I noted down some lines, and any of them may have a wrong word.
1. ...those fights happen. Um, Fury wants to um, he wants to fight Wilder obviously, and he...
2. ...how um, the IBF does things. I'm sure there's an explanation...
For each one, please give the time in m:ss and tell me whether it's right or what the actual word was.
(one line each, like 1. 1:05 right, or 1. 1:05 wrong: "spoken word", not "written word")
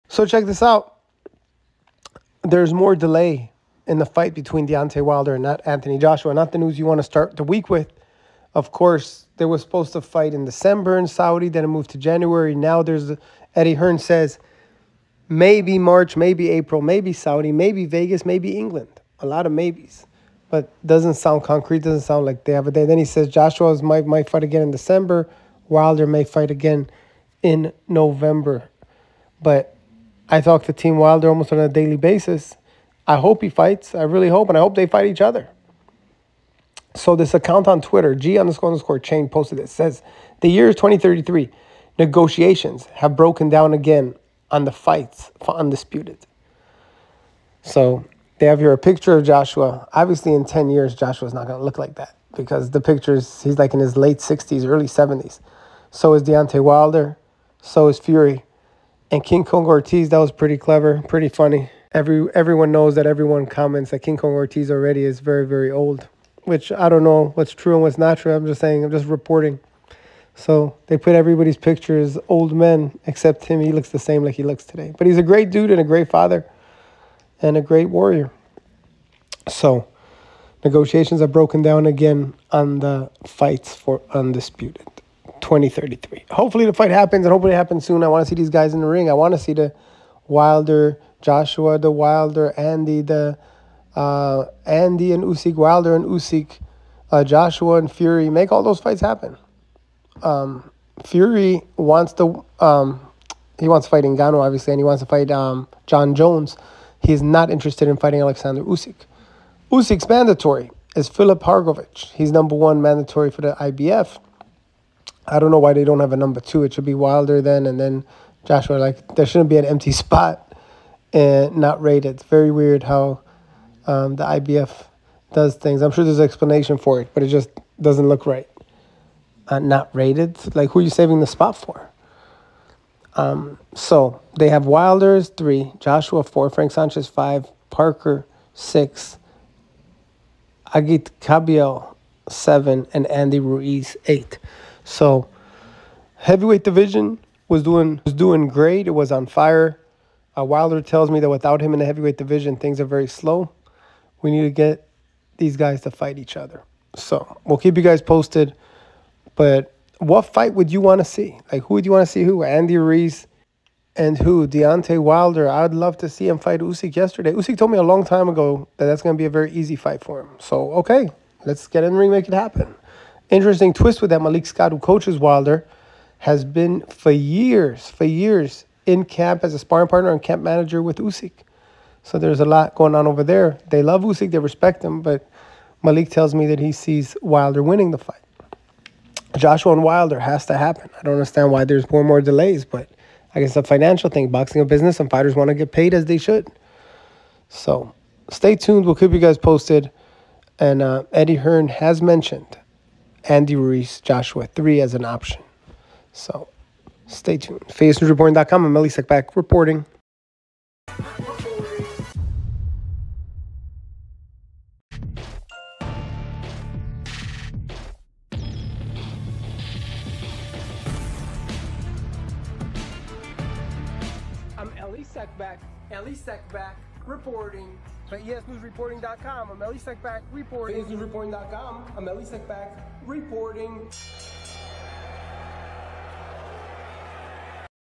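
1. 1:38 wrong: "Ngannou", not "Wilder"
2. 2:02 right.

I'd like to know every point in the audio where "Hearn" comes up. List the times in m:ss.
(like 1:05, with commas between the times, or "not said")
0:13, 3:21.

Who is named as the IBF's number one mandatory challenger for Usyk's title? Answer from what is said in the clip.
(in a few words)
Filip Hrgovic.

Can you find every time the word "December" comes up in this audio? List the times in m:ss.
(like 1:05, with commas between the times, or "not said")
0:10, 0:24.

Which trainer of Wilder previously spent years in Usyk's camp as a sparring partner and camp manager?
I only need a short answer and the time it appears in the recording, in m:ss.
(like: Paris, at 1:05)
Malik Scott, at 2:54.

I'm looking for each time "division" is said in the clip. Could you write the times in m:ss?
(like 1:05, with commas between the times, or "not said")
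2:26, 2:32.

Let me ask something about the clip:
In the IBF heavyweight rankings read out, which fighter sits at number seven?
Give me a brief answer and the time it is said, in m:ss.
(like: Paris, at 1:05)
Agit Kabayel, at 2:20.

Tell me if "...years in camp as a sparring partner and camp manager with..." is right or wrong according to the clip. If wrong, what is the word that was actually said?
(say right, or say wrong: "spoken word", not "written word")
right.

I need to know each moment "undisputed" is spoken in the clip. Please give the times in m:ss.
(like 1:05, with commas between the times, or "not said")
0:45, 1:24.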